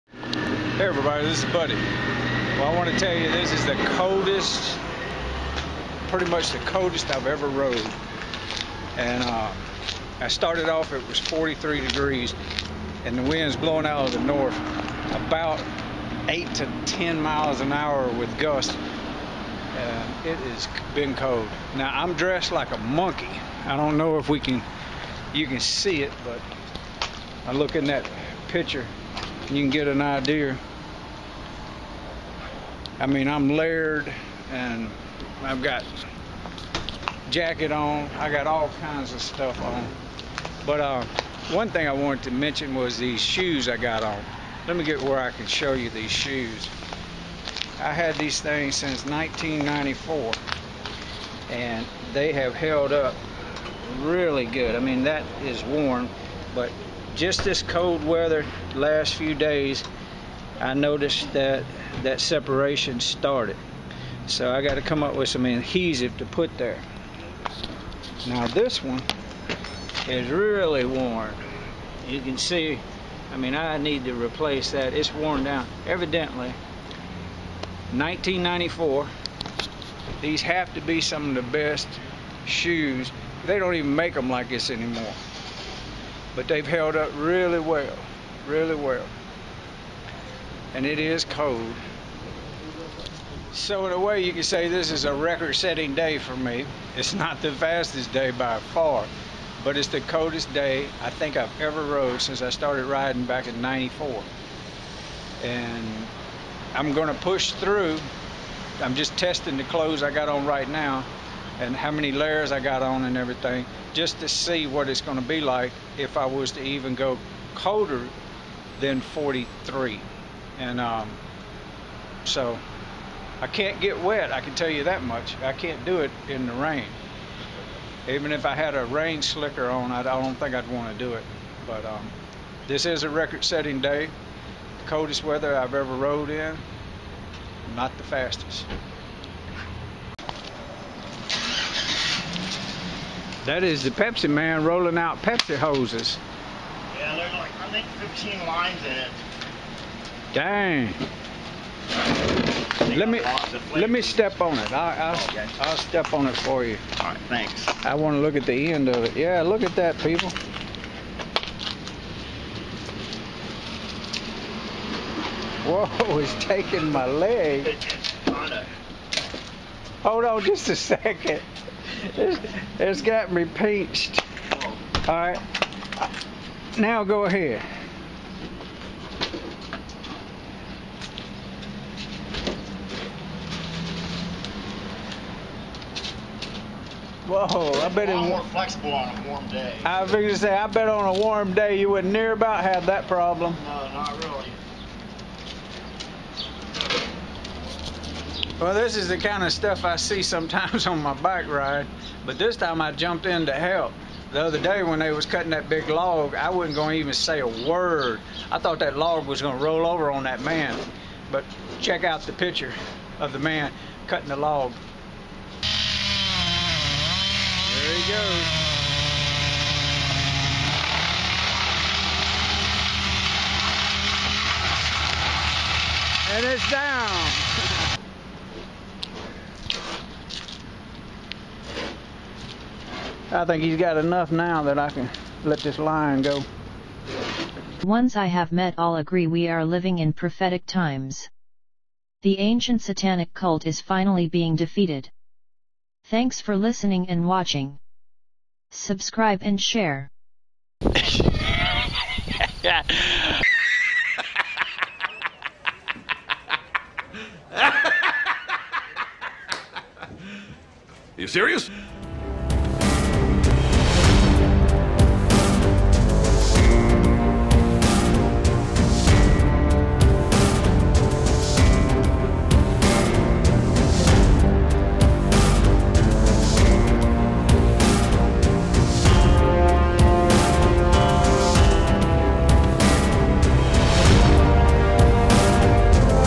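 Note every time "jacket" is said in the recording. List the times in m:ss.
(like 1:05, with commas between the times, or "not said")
0:37.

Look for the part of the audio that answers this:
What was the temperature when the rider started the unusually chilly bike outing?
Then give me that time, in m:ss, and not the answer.
0:11.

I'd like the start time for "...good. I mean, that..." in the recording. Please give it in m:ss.
0:54.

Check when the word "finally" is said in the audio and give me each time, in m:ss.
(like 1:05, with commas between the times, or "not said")
4:03.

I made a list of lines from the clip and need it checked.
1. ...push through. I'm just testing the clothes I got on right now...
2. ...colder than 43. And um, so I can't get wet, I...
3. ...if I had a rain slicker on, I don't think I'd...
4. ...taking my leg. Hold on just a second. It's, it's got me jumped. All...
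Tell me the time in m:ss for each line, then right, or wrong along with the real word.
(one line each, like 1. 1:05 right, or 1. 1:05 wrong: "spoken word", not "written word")
1. 1:47 right
2. 1:57 right
3. 2:08 right
4. 2:46 wrong: "pinched", not "jumped".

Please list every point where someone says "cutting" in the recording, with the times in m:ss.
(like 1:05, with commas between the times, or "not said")
3:25, 3:34.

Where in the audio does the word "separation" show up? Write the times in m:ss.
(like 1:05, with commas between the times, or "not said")
1:02.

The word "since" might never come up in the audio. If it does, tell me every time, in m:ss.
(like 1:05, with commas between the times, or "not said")
0:48, 1:42.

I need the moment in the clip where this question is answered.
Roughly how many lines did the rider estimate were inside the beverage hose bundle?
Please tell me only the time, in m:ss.
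2:28.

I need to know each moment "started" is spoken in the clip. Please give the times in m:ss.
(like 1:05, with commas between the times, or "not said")
0:10, 1:02, 1:42.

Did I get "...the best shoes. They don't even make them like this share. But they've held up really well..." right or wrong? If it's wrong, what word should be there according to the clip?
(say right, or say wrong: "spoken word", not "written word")
wrong: "anymore", not "share".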